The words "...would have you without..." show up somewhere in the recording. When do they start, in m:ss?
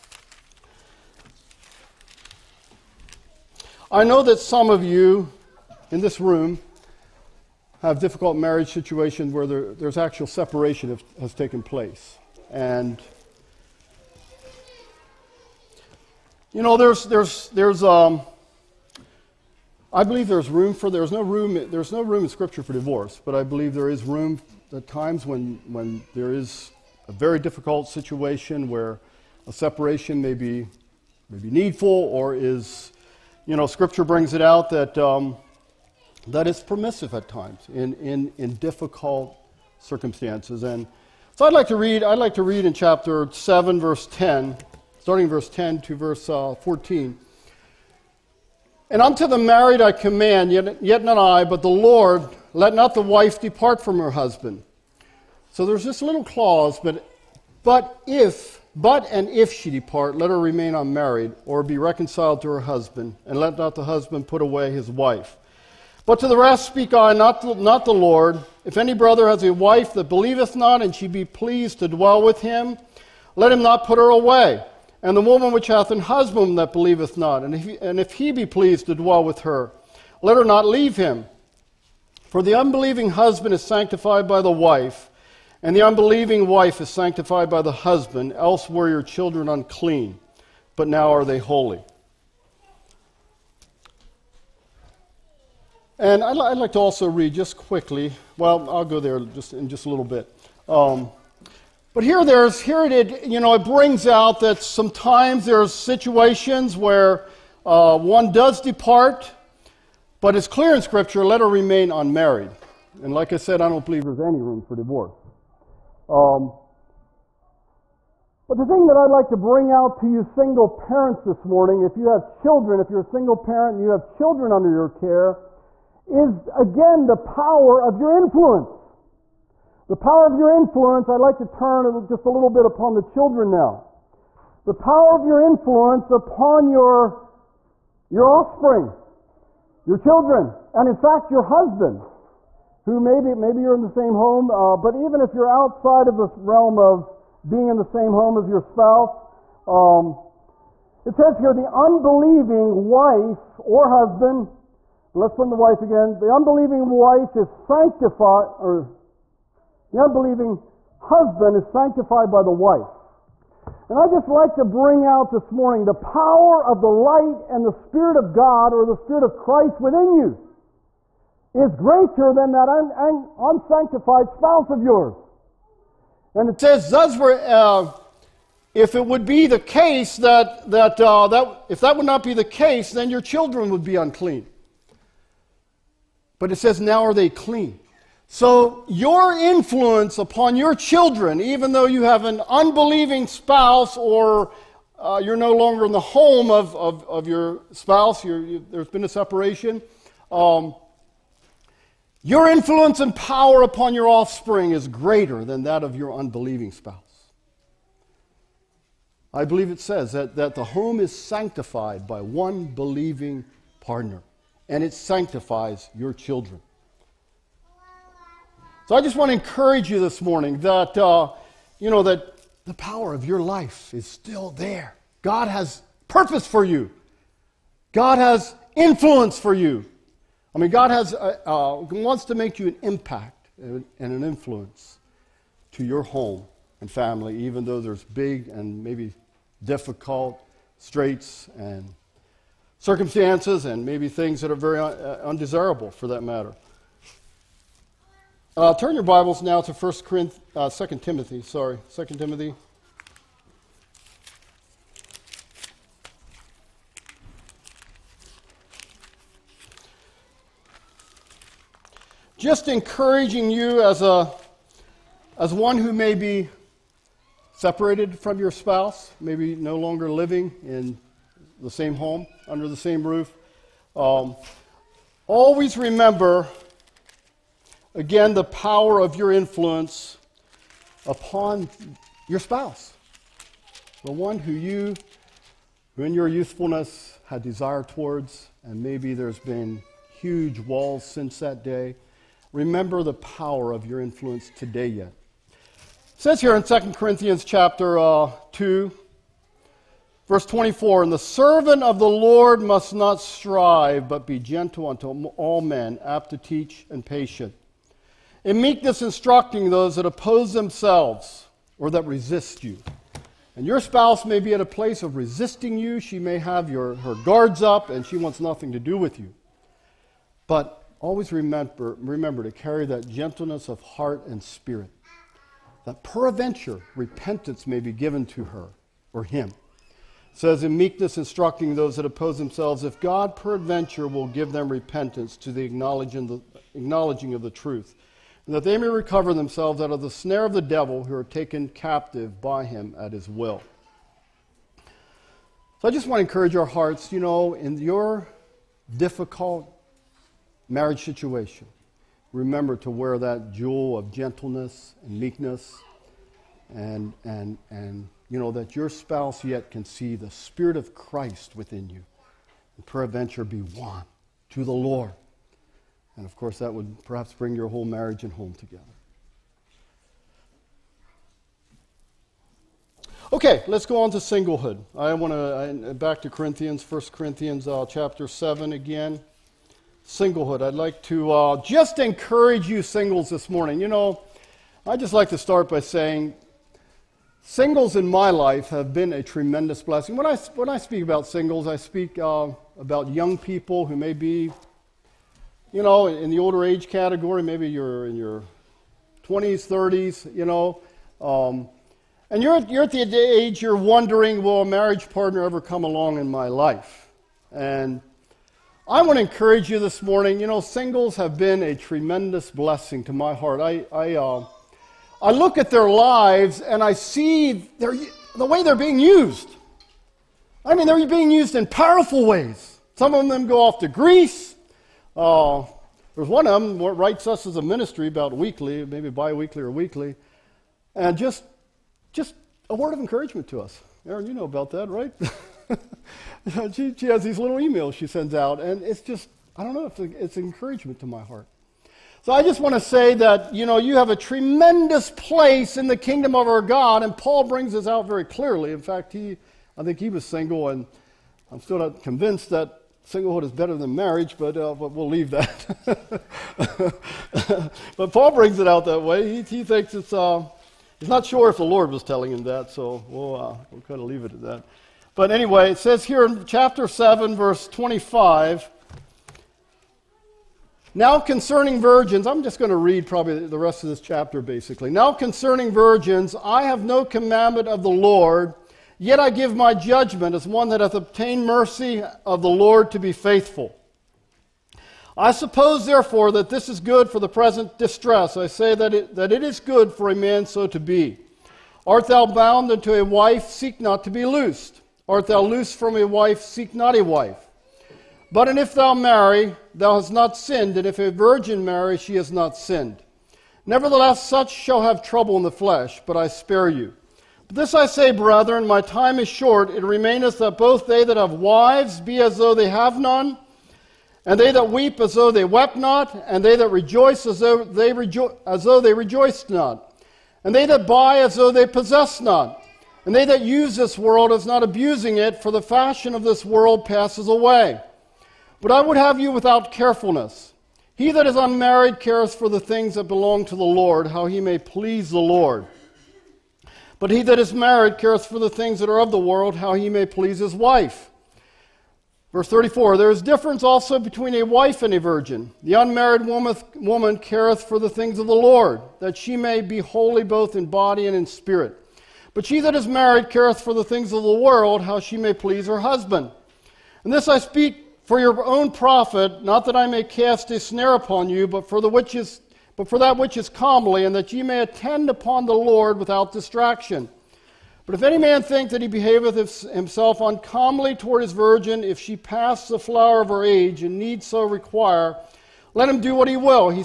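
8:48.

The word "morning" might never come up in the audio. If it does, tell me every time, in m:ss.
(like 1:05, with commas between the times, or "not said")
2:01, 2:45, 3:40, 6:23, 6:50.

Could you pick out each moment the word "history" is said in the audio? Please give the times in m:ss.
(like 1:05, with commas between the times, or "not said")
not said.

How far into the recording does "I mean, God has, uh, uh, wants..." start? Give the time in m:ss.
3:50.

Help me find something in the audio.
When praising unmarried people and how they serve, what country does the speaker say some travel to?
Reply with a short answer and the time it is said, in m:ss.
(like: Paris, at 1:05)
Greece, at 7:03.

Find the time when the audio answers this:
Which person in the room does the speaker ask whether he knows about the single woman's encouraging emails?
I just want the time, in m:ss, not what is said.
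7:14.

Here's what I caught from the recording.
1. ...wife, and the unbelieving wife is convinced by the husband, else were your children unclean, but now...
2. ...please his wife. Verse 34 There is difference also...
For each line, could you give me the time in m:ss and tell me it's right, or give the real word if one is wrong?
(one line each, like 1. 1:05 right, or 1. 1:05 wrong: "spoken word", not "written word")
1. 1:24 wrong: "sanctified", not "convinced"
2. 9:00 right.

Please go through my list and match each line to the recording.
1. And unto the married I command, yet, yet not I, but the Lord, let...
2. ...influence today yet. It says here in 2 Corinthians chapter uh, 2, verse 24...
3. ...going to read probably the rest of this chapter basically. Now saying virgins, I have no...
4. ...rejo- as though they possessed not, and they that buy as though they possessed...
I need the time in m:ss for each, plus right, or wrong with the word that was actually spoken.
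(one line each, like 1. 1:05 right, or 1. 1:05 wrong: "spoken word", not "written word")
1. 0:48 right
2. 4:53 right
3. 7:52 wrong: "concerning", not "saying"
4. 8:37 wrong: "rejoiced", not "possessed".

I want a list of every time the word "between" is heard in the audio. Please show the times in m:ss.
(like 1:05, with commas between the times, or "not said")
9:03.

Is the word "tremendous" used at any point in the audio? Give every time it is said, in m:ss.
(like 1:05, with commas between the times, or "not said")
6:29, 6:51, 7:24.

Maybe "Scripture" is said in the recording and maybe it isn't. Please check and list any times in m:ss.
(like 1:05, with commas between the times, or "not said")
0:22, 0:33, 1:50.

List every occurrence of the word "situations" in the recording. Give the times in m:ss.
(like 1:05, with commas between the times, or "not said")
0:08, 0:27, 1:45, 5:51.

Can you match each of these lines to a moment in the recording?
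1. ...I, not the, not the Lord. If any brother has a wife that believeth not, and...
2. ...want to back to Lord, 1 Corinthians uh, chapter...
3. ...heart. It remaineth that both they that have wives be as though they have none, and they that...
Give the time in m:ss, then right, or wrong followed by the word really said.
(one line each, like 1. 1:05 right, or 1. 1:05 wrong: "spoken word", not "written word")
1. 1:06 right
2. 6:15 wrong: "Corinthians", not "Lord"
3. 8:29 wrong: "short", not "heart".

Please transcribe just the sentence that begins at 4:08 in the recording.
Uh, turn your Bibles now to 1 Corinthians, uh, 2 Timothy, sorry, 2 Timothy.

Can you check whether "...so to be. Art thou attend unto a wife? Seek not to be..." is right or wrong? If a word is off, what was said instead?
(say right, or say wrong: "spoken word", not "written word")
wrong: "bound", not "attend".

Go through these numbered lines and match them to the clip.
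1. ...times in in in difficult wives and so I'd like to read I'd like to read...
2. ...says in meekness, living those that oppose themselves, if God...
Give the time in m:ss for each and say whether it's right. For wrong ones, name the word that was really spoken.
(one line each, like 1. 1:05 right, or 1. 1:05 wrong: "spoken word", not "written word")
1. 0:37 wrong: "circumstances", not "wives"
2. 5:30 wrong: "instructing", not "living".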